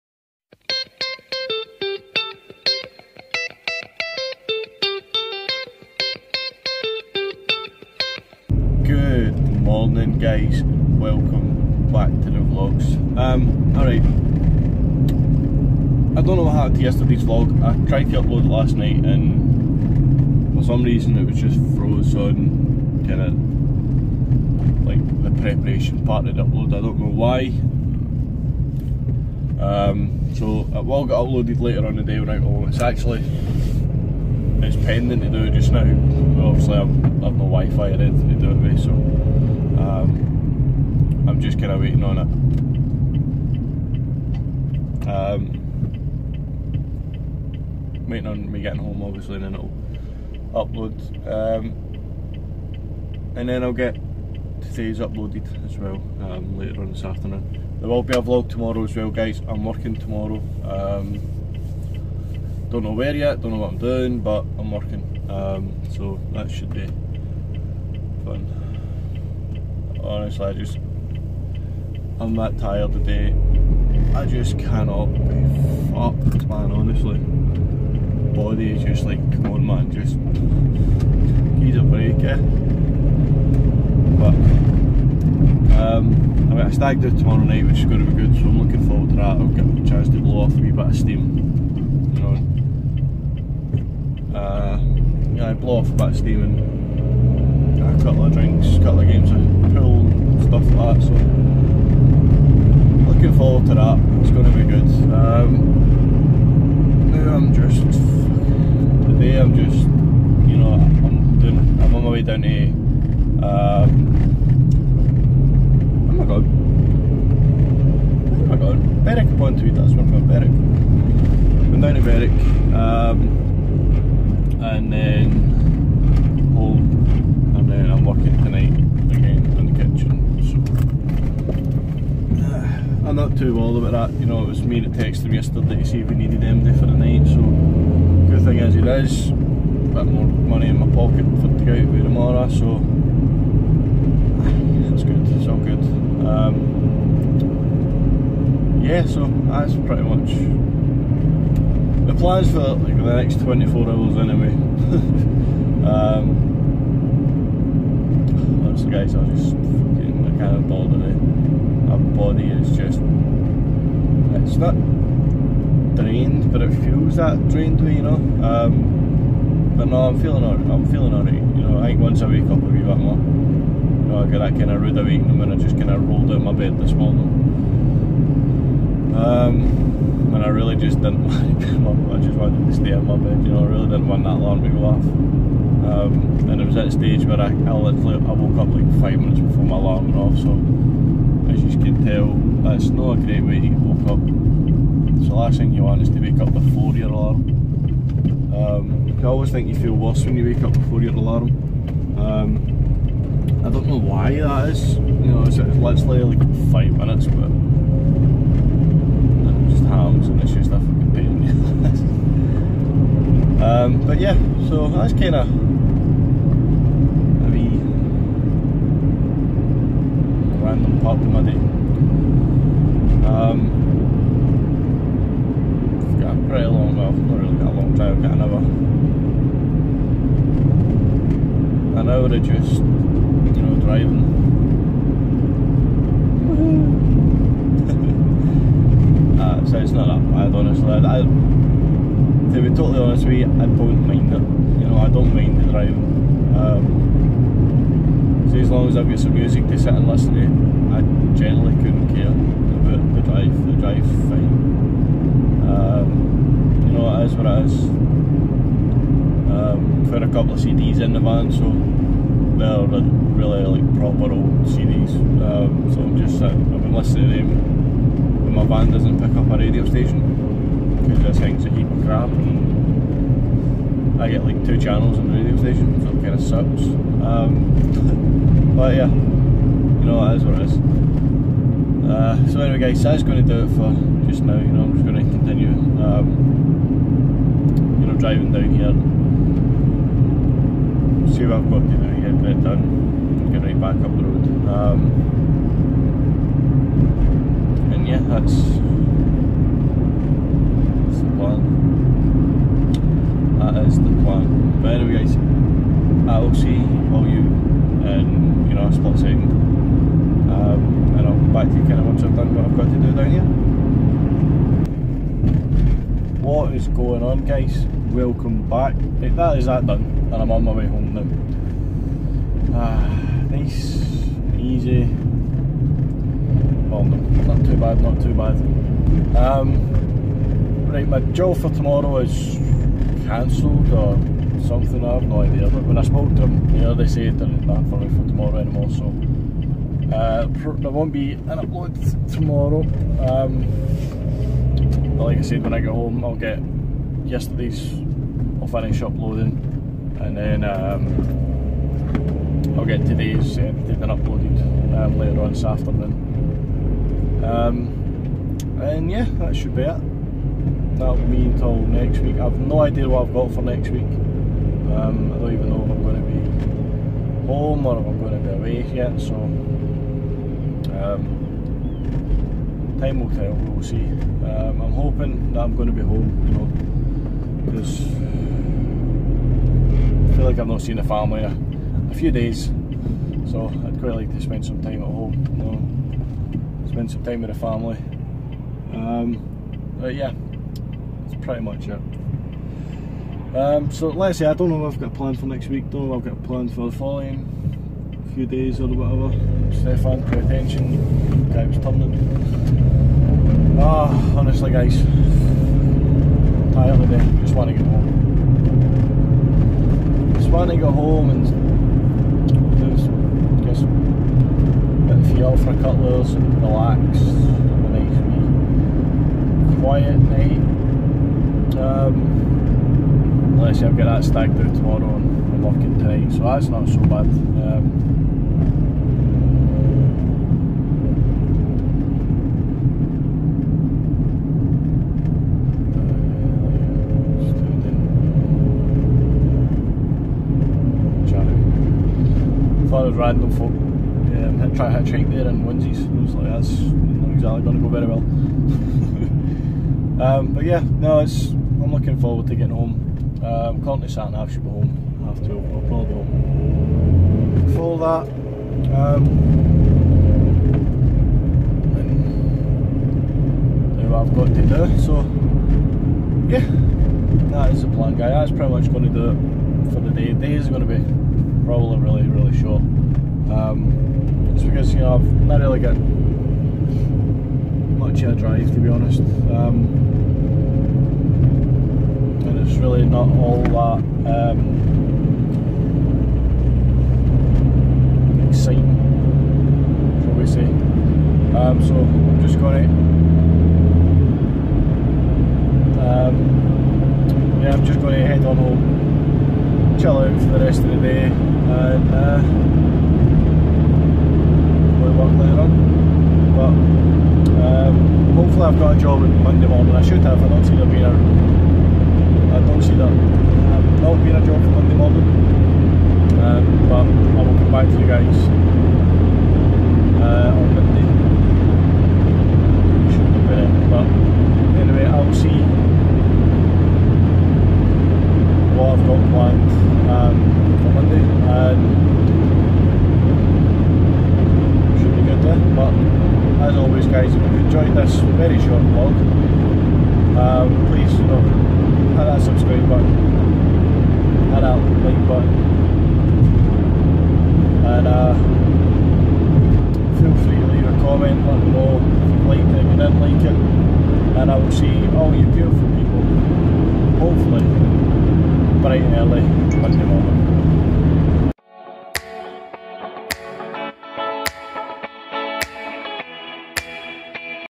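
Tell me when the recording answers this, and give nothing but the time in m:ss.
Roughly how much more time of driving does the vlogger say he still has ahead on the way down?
3:51.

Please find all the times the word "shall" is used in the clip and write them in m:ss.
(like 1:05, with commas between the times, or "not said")
8:10.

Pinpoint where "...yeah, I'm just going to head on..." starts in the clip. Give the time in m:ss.
8:17.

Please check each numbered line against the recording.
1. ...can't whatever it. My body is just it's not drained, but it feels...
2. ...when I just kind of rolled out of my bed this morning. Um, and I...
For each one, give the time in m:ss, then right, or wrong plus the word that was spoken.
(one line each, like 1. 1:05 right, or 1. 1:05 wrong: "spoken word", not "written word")
1. 2:40 wrong: "bother", not "whatever"
2. 2:55 right.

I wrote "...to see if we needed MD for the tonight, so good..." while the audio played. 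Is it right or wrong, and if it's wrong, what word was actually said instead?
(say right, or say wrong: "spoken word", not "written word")
wrong: "night", not "tonight".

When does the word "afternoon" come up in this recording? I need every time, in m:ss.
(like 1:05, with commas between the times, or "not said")
0:57, 5:55.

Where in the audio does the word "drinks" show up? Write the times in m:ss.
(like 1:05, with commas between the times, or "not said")
1:38.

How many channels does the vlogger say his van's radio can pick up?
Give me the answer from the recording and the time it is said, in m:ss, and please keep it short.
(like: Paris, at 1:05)
2, at 4:34.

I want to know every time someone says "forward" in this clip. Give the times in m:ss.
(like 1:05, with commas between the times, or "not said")
1:28, 1:43, 7:32.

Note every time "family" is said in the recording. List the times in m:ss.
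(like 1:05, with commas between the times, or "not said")
6:21, 6:27.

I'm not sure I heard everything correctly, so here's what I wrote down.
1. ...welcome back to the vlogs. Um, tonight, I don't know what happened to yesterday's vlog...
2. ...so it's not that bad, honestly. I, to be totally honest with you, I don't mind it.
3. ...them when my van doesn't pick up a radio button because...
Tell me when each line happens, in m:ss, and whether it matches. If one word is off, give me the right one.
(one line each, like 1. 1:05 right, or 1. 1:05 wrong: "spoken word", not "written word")
1. 0:11 wrong: "alright", not "tonight"
2. 3:59 right
3. 4:27 wrong: "station", not "button".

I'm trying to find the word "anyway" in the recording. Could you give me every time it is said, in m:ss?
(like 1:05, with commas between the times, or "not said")
2:34, 4:42, 5:04.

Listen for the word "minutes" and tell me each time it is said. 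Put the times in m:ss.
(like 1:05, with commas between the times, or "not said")
3:09, 3:26.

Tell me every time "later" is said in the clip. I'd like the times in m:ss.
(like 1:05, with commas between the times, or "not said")
0:31, 0:56, 5:55, 8:25.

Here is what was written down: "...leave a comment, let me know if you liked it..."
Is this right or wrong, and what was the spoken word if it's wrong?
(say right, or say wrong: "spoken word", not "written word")
right.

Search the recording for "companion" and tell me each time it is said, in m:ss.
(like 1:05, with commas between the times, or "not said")
not said.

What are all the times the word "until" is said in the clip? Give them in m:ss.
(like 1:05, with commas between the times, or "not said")
6:01.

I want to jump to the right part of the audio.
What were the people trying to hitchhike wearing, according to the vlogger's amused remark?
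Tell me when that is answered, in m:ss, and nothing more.
7:25.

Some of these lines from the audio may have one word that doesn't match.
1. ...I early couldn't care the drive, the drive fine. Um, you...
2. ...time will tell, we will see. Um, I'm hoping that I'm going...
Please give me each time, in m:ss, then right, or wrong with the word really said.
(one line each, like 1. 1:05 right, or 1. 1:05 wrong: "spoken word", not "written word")
1. 4:10 wrong: "generally", not "early"
2. 6:13 right.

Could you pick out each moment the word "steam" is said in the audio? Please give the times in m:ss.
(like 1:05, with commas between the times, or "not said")
1:30, 1:36.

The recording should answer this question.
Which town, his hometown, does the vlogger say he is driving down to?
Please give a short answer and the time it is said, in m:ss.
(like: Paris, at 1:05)
Berwick upon Tweed, at 1:59.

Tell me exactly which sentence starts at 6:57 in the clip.
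Have a nice wee quiet night.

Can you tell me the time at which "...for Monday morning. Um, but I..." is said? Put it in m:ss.
8:34.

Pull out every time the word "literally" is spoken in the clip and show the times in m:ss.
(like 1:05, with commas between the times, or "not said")
3:07, 3:25.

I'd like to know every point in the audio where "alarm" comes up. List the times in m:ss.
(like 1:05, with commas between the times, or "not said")
3:04, 3:09, 3:17, 3:21.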